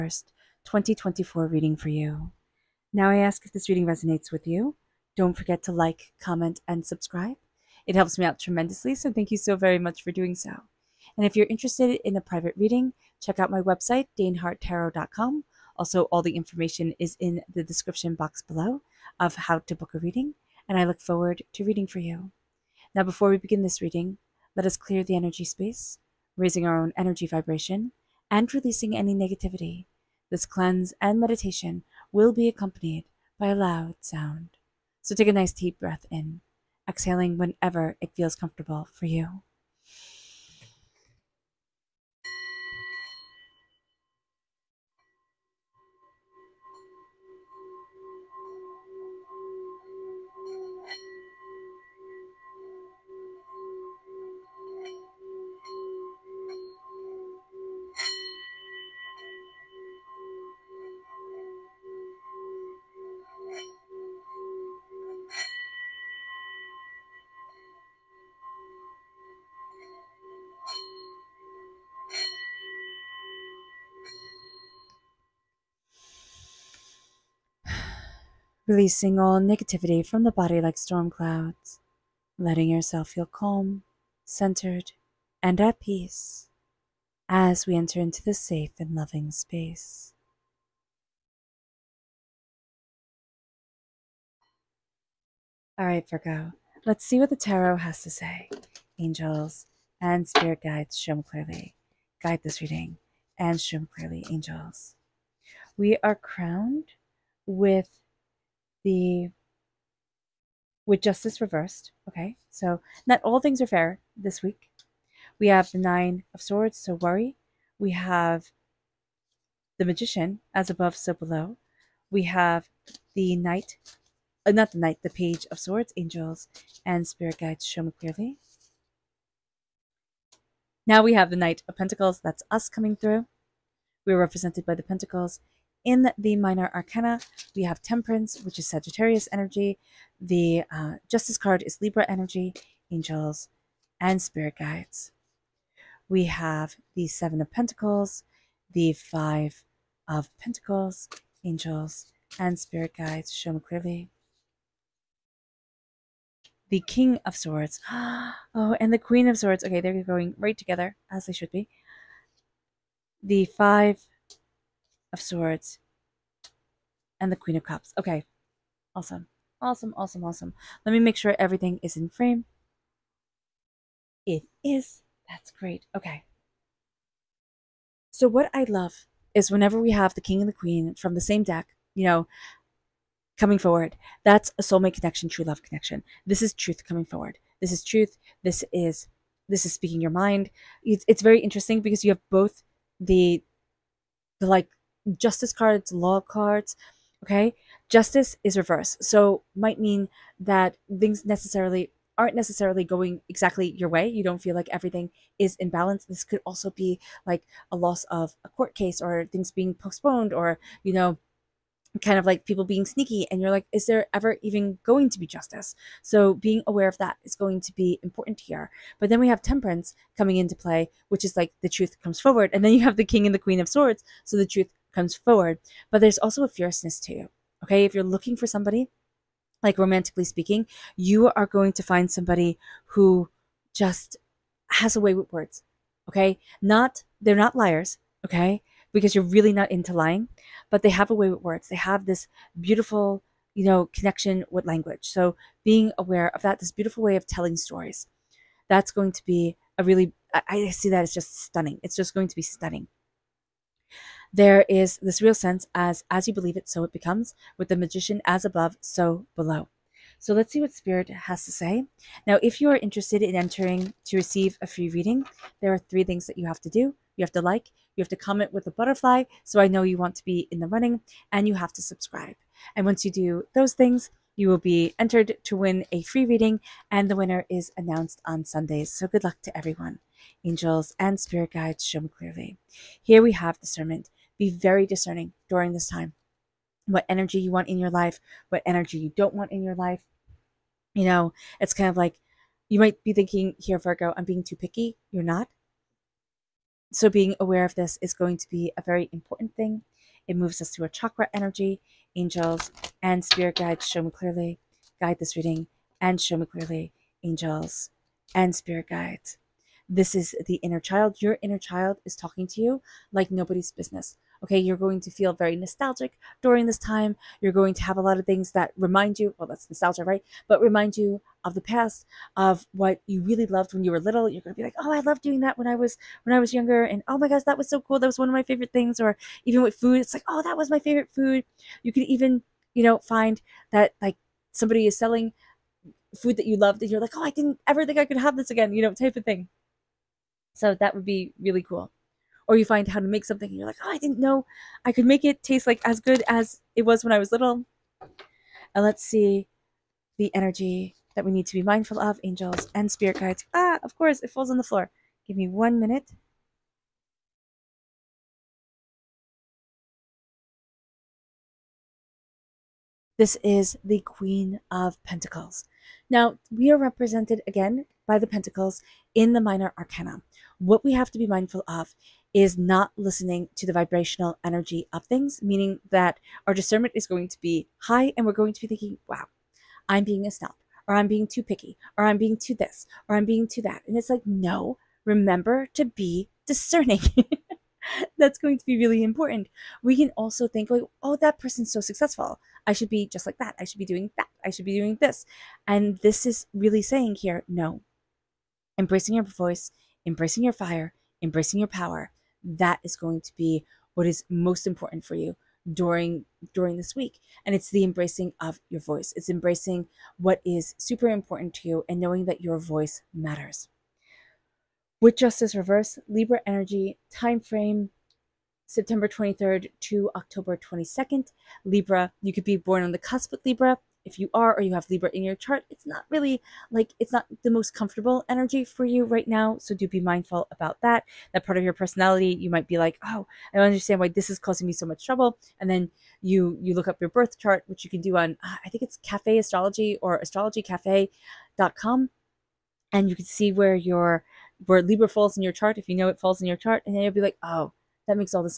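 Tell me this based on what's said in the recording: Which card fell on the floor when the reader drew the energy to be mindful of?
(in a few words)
Queen of Pentacles.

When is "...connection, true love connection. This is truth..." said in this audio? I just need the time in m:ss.
3:04.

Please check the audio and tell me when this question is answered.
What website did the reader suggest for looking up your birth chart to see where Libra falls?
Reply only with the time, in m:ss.
7:19.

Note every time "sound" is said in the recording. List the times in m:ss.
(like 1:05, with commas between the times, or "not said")
0:34.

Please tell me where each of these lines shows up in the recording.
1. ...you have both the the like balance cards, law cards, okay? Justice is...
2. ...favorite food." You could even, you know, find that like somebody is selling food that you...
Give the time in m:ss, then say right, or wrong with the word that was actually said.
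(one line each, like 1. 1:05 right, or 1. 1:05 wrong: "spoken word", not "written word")
1. 3:12 wrong: "justice", not "balance"
2. 5:30 right.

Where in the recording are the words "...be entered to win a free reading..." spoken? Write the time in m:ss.
4:34.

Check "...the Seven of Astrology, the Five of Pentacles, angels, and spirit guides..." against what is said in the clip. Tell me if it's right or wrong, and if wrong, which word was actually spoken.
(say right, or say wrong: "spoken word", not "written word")
wrong: "Pentacles", not "Astrology".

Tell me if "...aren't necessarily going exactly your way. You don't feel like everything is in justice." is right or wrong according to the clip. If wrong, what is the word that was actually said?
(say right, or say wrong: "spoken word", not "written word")
wrong: "balance", not "justice".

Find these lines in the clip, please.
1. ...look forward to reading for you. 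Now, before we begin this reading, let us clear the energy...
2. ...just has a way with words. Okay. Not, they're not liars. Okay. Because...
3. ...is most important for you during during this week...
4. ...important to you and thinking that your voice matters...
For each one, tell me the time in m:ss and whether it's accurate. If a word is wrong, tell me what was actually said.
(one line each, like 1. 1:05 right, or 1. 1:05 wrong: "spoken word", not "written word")
1. 0:20 right
2. 3:53 right
3. 6:44 right
4. 6:51 wrong: "knowing", not "thinking".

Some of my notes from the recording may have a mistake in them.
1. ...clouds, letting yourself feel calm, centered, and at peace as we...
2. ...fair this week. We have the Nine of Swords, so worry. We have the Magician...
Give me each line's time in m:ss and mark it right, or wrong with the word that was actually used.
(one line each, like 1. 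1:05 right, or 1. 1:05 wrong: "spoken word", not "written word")
1. 1:21 right
2. 1:53 right.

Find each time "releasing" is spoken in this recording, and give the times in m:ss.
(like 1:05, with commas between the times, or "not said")
0:28, 1:18.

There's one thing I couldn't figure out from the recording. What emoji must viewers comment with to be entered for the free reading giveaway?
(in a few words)
butterfly.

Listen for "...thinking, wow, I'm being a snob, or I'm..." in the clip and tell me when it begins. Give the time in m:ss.
6:18.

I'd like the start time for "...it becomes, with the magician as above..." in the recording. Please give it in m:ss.
4:16.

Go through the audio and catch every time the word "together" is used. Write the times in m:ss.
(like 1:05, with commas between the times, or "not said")
2:40.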